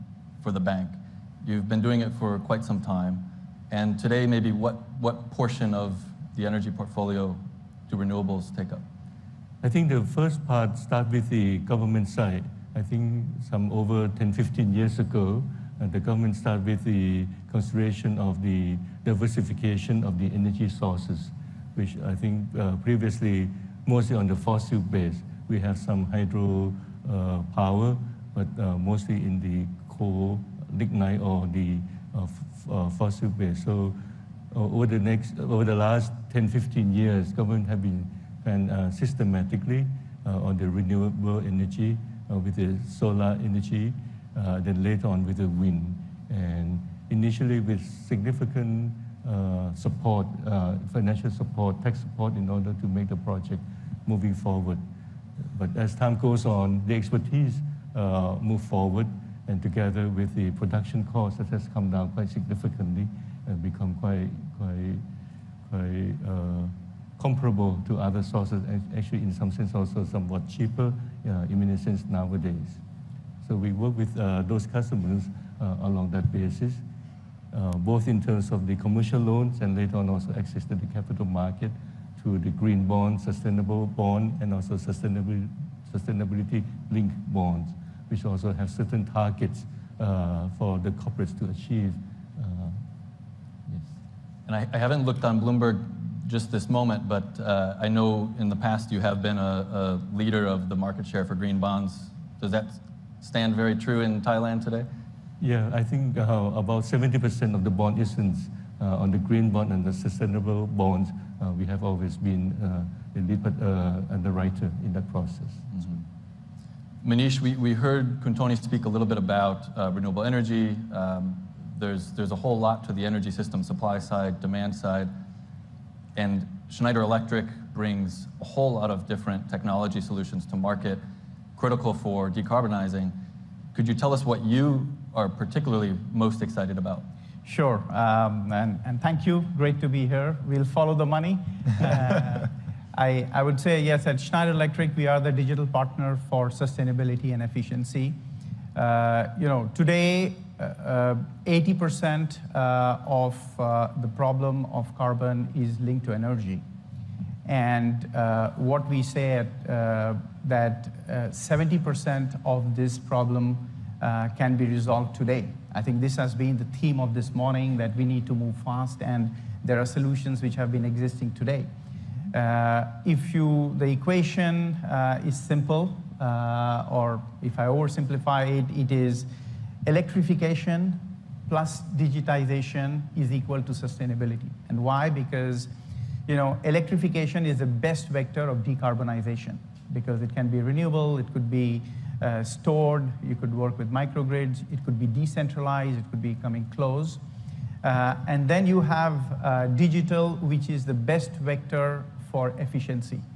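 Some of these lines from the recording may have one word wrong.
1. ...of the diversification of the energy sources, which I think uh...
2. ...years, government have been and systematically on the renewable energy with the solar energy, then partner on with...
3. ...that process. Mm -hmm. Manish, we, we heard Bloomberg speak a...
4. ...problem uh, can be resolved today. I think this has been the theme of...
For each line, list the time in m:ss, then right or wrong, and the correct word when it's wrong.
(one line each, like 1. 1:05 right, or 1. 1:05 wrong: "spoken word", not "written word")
1. 0:18 right
2. 0:36 wrong: "later", not "partner"
3. 1:54 wrong: "Kuntoni", not "Bloomberg"
4. 2:42 right.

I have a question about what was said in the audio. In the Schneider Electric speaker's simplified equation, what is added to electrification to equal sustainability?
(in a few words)
digitization.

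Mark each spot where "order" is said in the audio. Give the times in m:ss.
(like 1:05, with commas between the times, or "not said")
0:52.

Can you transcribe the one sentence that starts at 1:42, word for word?
Does that stand very true in Thailand today?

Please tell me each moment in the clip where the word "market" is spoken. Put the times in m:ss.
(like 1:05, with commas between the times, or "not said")
1:21, 1:40, 2:10.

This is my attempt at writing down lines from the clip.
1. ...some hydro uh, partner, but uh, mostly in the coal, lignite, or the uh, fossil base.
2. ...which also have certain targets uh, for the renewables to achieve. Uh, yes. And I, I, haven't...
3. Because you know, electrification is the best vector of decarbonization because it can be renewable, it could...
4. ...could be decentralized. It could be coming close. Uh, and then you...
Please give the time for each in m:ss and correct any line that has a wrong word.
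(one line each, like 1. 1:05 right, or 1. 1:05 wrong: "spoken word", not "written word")
1. 0:25 wrong: "power", not "partner"
2. 1:28 wrong: "corporates", not "renewables"
3. 3:05 right
4. 3:14 right.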